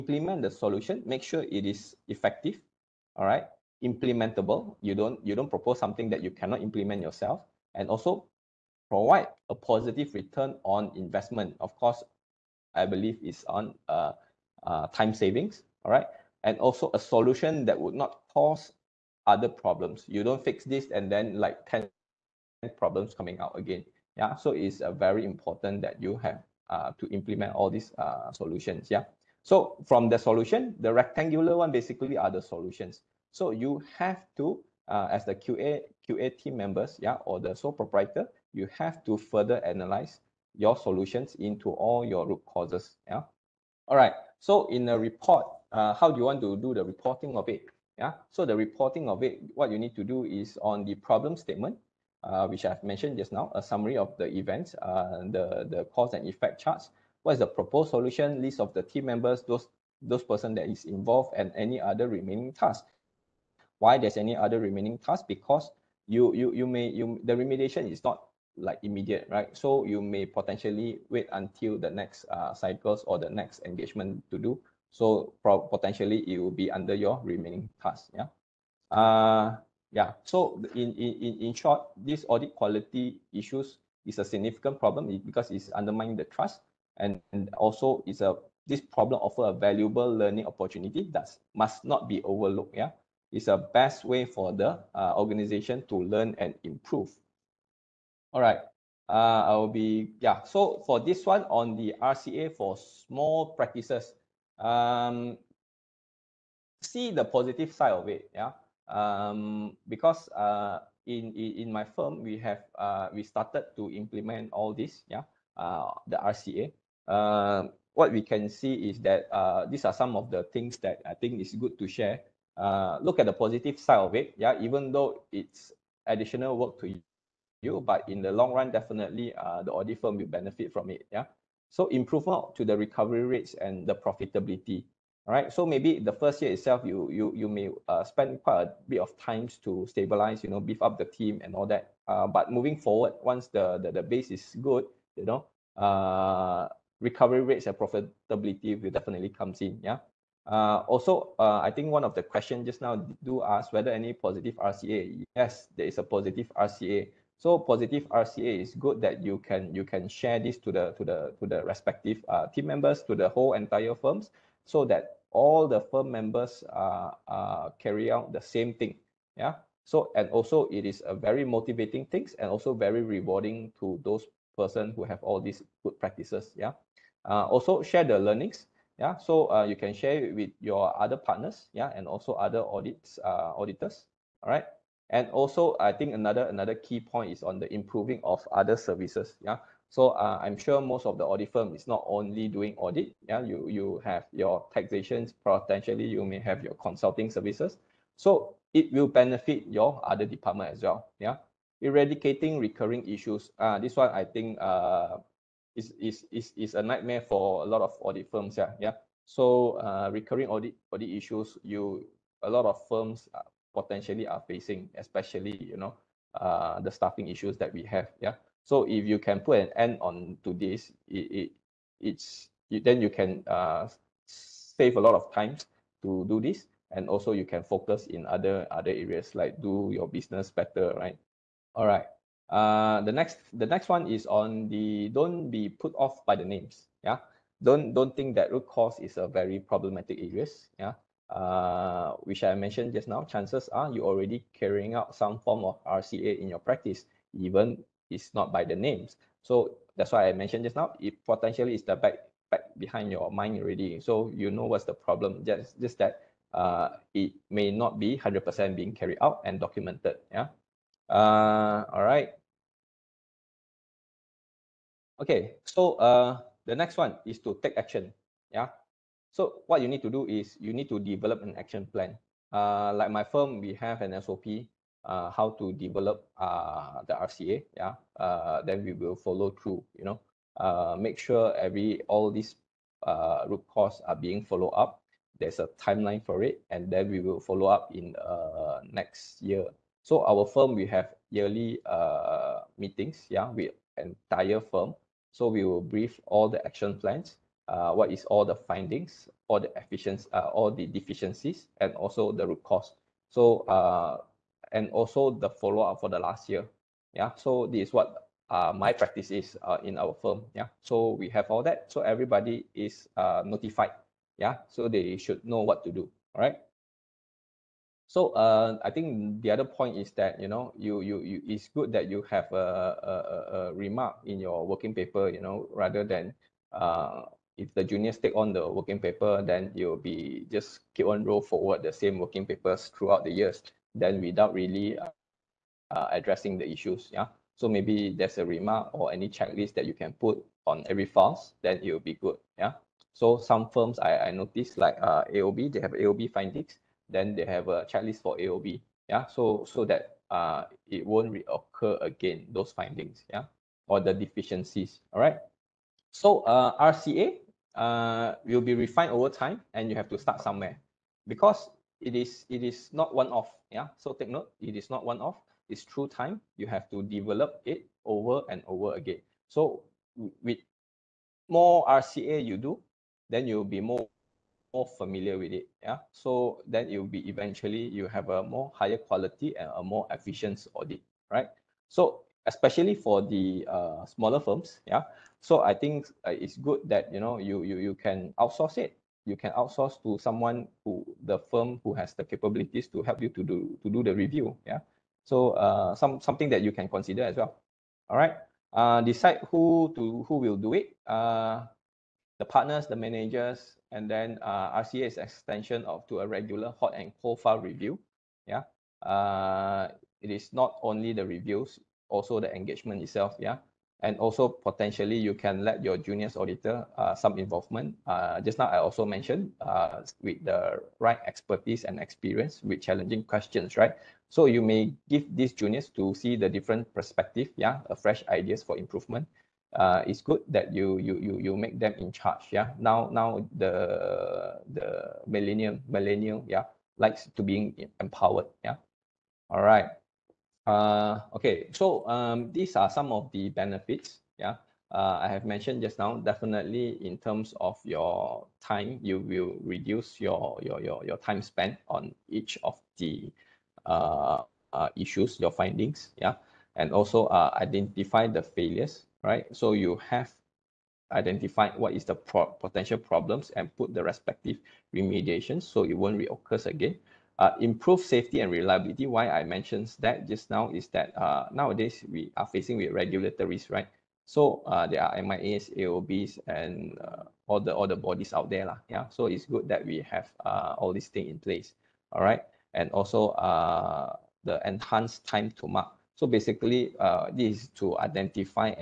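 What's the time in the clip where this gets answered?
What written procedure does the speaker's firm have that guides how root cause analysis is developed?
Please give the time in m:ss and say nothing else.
4:34.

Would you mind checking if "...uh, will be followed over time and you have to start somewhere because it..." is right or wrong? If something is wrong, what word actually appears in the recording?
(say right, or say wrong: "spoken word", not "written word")
wrong: "refined", not "followed".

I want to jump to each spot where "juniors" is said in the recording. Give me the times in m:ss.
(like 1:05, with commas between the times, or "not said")
5:27, 6:55, 7:05.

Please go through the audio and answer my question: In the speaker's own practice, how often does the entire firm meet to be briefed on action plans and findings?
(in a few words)
yearly.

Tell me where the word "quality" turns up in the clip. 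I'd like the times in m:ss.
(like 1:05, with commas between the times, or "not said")
1:22, 6:18.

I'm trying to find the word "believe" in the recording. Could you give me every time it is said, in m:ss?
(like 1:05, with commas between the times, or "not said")
0:12.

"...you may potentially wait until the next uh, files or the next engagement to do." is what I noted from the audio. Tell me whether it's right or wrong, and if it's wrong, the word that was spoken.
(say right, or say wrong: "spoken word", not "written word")
wrong: "cycles", not "files".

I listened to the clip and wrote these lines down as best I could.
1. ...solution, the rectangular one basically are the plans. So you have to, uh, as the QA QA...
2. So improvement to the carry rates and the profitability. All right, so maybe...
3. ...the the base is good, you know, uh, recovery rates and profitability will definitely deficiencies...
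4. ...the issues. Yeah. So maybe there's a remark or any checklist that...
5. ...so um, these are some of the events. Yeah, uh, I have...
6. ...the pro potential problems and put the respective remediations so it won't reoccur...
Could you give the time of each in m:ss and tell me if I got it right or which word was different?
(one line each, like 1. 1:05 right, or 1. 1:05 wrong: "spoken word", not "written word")
1. 0:30 wrong: "solutions", not "plans"
2. 2:11 wrong: "recovery", not "carry"
3. 2:23 wrong: "comes", not "deficiencies"
4. 5:36 right
5. 7:21 wrong: "benefits", not "events"
6. 7:42 right.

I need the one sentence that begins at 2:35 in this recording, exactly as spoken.
Yes, there is a positive RCA.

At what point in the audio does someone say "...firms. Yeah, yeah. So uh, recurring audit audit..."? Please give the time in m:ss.
3:28.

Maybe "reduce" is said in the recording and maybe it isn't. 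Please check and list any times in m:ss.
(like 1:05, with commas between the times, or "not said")
7:29.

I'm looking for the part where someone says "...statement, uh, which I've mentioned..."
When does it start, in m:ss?
0:51.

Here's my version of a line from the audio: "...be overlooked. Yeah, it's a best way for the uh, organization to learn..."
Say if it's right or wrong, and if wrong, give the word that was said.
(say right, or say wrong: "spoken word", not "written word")
right.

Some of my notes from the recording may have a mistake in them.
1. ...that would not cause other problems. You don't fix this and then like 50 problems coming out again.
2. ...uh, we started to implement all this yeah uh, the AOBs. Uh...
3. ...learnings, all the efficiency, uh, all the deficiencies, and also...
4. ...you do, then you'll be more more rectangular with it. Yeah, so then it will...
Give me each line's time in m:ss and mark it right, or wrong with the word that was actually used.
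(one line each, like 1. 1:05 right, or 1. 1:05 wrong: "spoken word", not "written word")
1. 0:17 wrong: "10", not "50"
2. 1:52 wrong: "RCA", not "AOBs"
3. 4:58 wrong: "findings", not "learnings"
4. 6:12 wrong: "familiar", not "rectangular".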